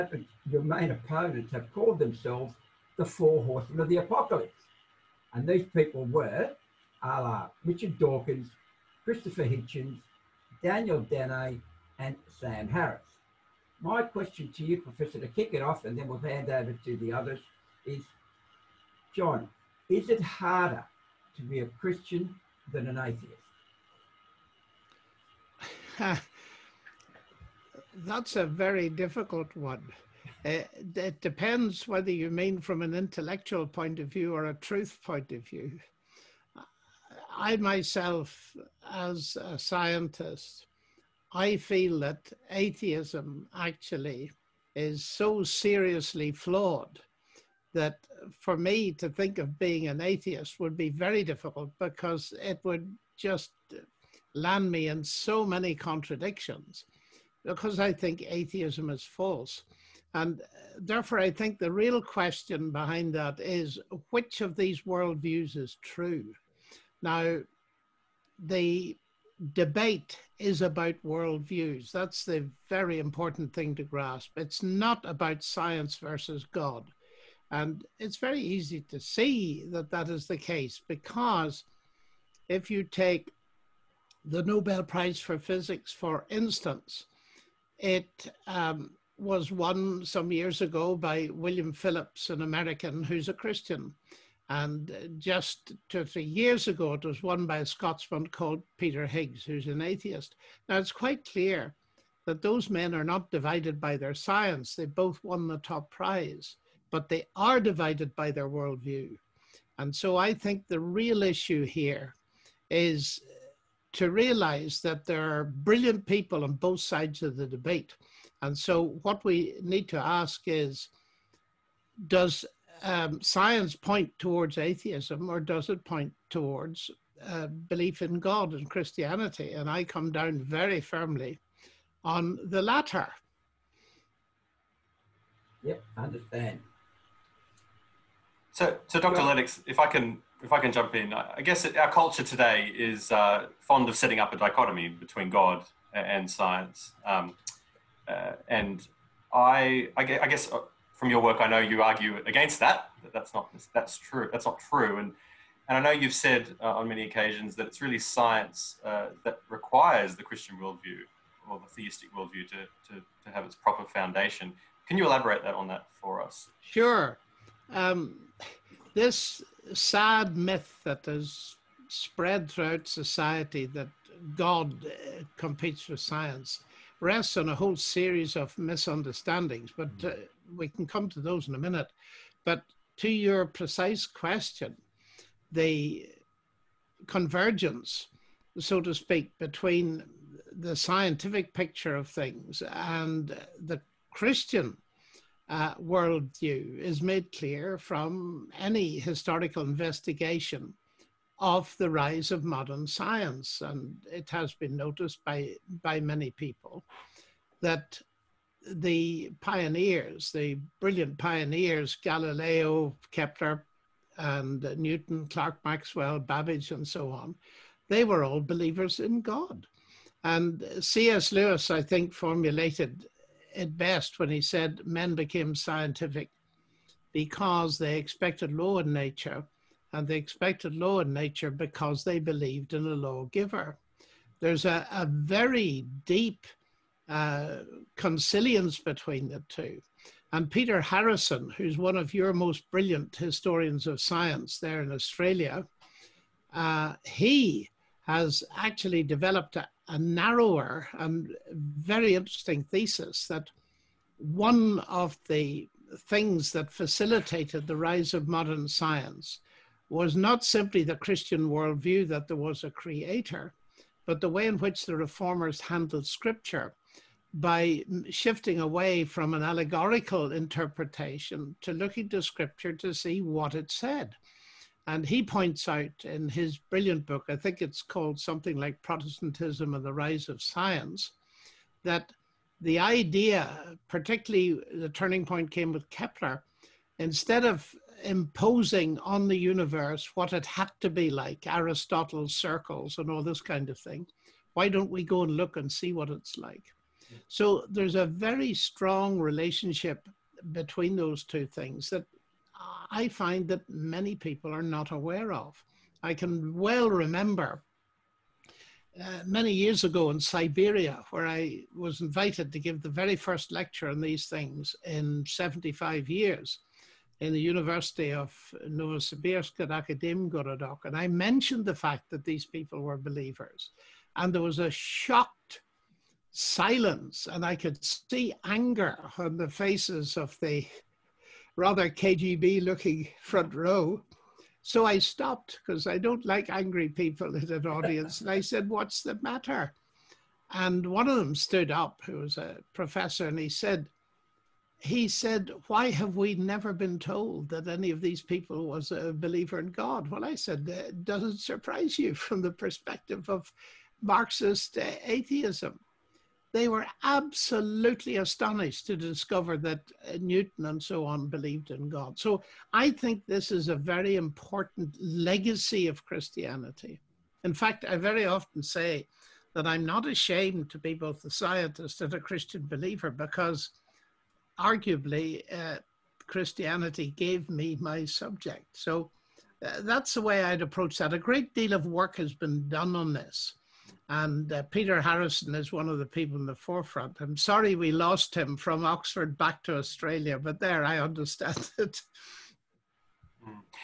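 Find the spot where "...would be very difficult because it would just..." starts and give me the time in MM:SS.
00:50.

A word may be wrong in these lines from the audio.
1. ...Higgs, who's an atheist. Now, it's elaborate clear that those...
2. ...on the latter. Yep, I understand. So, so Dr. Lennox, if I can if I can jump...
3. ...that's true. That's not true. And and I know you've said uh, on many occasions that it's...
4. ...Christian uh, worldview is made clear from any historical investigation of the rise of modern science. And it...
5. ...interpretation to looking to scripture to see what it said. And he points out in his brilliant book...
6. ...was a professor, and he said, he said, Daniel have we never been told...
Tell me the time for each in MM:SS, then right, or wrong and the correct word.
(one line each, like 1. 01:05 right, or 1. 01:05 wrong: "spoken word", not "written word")
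1. 01:39 wrong: "quite", not "elaborate"
2. 02:12 right
3. 02:33 right
4. 03:14 right
5. 04:30 right
6. 05:42 wrong: "Why", not "Daniel".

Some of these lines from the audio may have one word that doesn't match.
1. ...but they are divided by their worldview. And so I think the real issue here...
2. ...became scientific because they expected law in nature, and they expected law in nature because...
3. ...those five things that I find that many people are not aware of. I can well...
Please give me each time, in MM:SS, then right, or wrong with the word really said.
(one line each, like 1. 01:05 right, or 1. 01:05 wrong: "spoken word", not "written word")
1. 01:46 right
2. 03:45 right
3. 05:00 wrong: "two", not "five".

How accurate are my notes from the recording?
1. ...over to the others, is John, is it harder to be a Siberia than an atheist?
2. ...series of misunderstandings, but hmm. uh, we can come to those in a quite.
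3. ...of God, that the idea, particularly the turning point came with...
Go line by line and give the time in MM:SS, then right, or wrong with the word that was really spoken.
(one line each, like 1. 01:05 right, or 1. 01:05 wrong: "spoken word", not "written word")
1. 00:16 wrong: "Christian", not "Siberia"
2. 02:57 wrong: "minute", not "quite"
3. 04:40 wrong: "Science", not "God".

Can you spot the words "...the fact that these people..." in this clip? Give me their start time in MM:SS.
05:21.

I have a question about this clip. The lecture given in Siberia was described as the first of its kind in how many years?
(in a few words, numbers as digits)
75.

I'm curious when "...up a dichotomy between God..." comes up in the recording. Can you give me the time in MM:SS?
02:24.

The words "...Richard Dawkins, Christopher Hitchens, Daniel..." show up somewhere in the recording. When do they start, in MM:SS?
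00:07.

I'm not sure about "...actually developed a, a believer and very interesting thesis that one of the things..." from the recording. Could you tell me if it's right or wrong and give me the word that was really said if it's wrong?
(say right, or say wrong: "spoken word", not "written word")
wrong: "narrower", not "believer".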